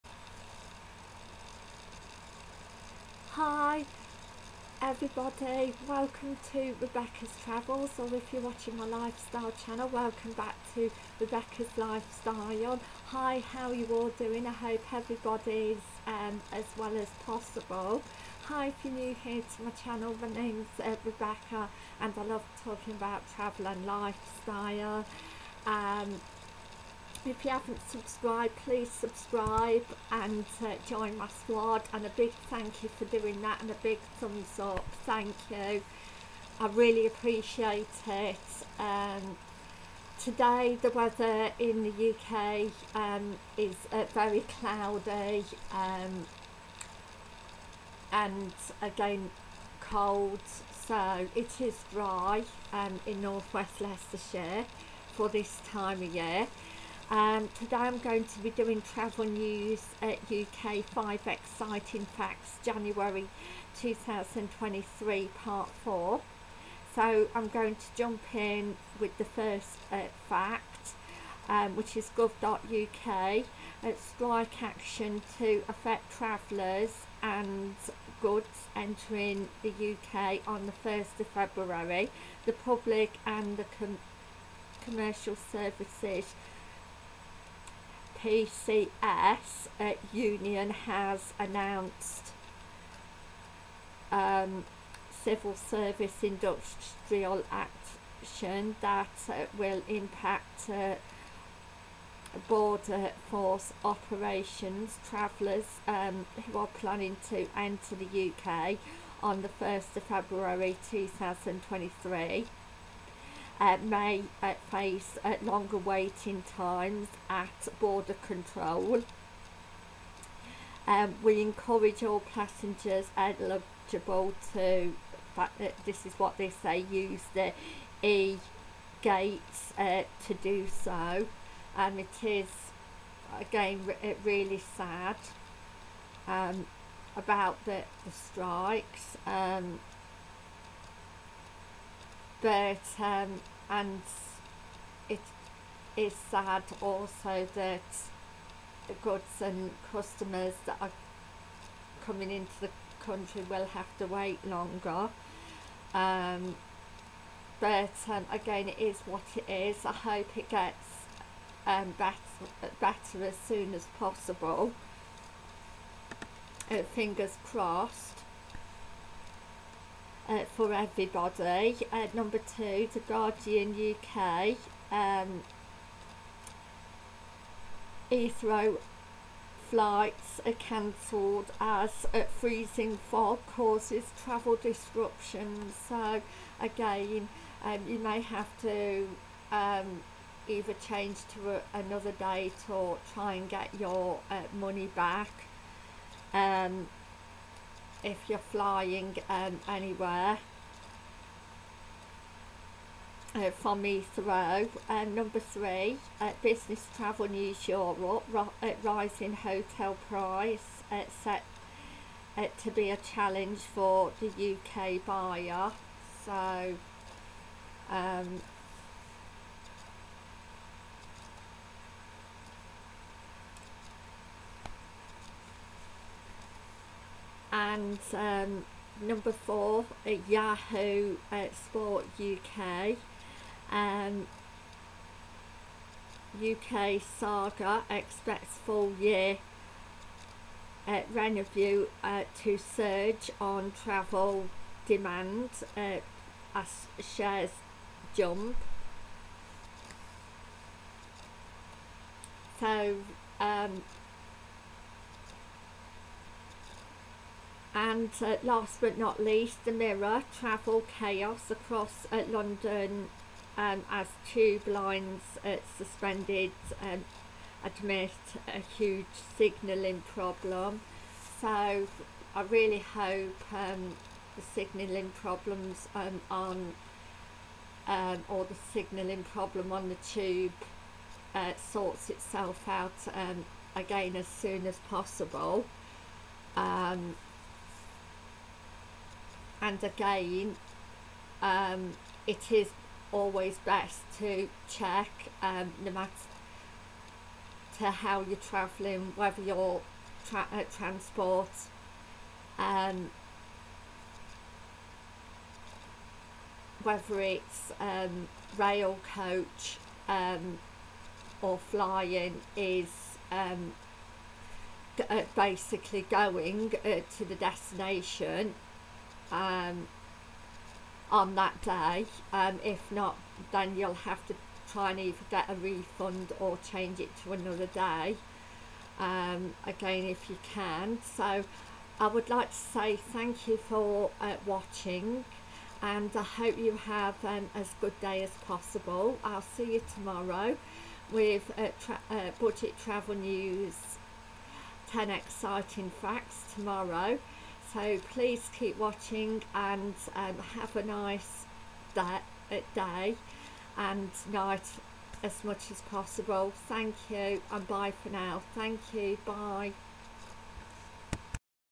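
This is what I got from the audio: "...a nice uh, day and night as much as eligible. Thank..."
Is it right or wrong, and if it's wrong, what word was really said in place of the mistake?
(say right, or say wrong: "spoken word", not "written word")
wrong: "possible", not "eligible".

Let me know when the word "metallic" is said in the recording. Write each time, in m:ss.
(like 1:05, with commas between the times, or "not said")
not said.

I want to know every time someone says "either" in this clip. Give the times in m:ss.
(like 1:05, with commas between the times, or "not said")
3:10, 5:24.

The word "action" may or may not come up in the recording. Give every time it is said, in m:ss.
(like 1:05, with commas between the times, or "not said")
1:14, 1:37.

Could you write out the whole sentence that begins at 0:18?
Hi, if you're new here to my channel, my name's uh, Rebecca and I love talking about travel and lifestyle.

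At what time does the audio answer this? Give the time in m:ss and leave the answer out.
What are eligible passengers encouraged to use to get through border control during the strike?
2:08.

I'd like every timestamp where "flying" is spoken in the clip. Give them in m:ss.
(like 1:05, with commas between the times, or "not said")
3:18, 5:11.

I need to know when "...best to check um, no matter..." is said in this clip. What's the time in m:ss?
4:53.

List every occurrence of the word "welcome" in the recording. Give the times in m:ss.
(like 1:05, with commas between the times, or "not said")
0:05, 0:09.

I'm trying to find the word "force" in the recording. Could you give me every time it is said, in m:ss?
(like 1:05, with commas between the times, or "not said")
1:43.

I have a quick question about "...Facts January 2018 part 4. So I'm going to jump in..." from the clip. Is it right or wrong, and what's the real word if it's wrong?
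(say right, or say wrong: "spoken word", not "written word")
wrong: "2023", not "2018".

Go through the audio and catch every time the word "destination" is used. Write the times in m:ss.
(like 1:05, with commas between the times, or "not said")
5:17.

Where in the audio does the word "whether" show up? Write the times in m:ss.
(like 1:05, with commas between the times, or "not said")
4:59, 5:06.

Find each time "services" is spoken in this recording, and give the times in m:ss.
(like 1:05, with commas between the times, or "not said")
1:25, 1:35.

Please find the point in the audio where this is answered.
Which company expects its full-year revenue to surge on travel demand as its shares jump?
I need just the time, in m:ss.
3:57.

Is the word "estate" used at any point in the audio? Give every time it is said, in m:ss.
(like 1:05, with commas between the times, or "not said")
not said.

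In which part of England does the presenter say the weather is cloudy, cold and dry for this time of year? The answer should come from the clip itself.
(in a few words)
northwest Leicestershire.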